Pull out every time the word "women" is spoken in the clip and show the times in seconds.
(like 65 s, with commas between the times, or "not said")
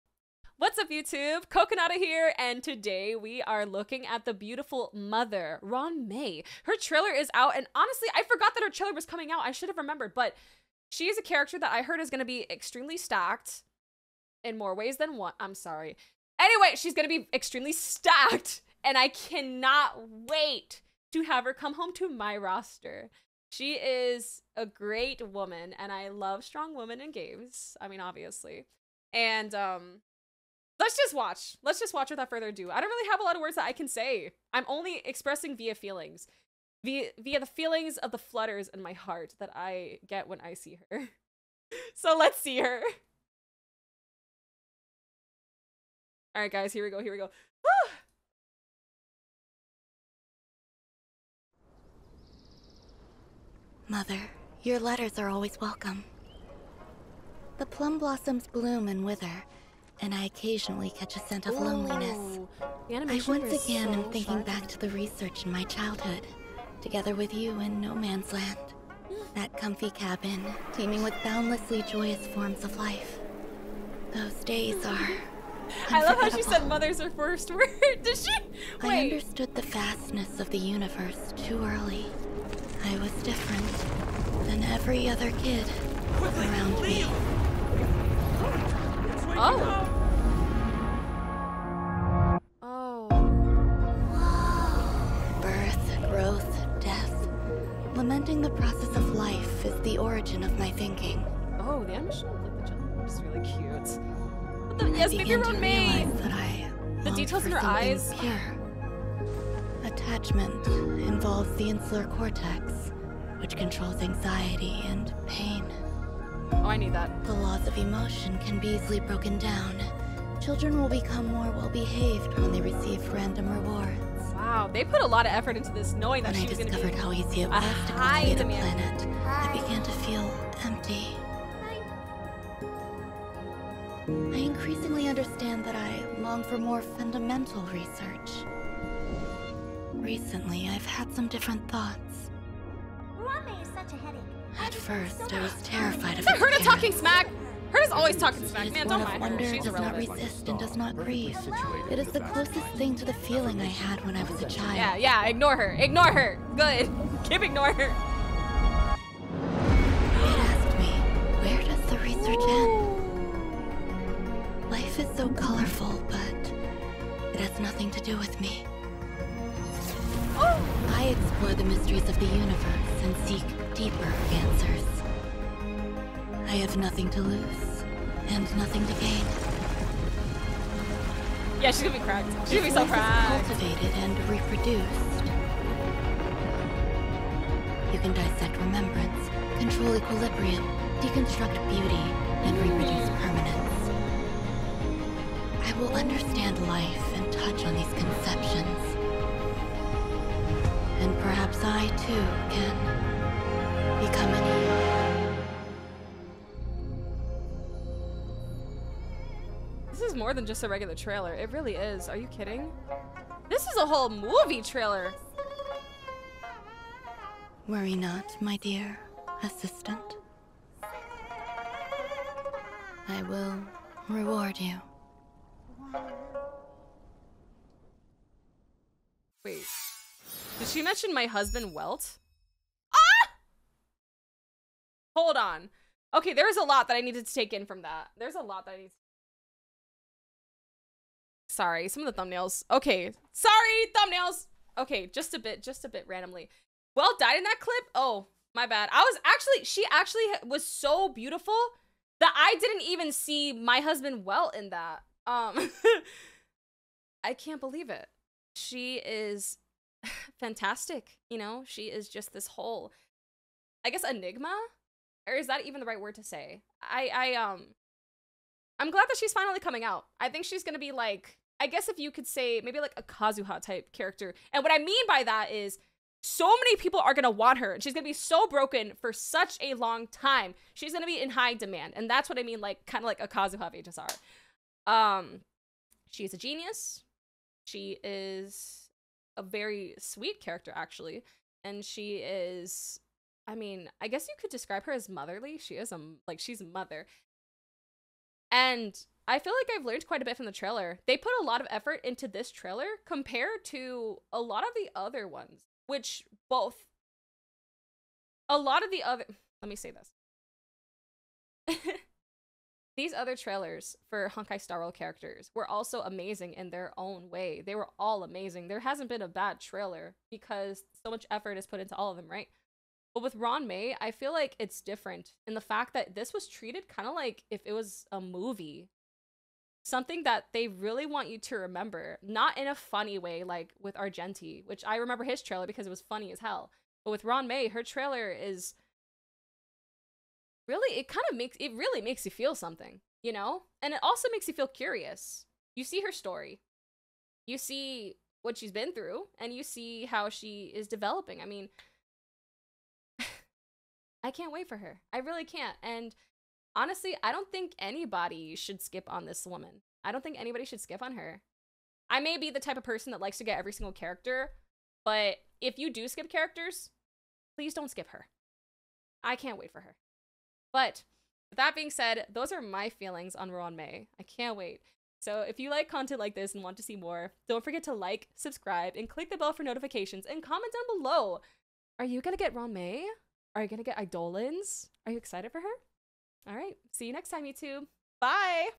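26 s.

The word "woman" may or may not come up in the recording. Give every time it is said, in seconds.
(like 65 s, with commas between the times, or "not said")
25 s, 359 s.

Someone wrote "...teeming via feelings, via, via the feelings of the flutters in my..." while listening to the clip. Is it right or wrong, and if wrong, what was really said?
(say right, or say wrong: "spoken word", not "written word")
wrong: "expressing", not "teeming".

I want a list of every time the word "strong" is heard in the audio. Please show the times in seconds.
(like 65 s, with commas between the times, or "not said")
26 s.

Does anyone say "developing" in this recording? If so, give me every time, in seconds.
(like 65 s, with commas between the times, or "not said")
350 s.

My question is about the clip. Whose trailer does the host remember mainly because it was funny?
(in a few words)
Argenti.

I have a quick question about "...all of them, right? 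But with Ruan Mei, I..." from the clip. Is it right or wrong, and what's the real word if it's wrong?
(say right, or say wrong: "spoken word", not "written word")
right.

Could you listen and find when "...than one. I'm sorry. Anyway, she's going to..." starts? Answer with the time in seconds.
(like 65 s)
14 s.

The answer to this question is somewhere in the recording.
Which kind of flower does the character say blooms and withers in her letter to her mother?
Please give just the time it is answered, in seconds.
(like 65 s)
57 s.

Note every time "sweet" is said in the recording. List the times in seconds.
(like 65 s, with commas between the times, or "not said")
289 s.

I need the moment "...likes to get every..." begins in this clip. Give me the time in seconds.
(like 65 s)
363 s.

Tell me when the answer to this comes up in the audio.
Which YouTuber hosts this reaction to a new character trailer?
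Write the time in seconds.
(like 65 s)
1 s.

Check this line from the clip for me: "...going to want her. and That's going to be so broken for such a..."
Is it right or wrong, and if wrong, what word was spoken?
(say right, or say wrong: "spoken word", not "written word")
wrong: "She", not "That".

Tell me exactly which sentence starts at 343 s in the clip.
And it also makes you feel curious.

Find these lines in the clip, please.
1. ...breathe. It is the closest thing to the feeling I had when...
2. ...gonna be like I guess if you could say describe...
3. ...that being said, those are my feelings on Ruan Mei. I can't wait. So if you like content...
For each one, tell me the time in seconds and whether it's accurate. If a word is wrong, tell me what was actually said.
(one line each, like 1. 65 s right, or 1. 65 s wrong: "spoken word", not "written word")
1. 150 s right
2. 270 s wrong: "maybe", not "describe"
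3. 371 s right.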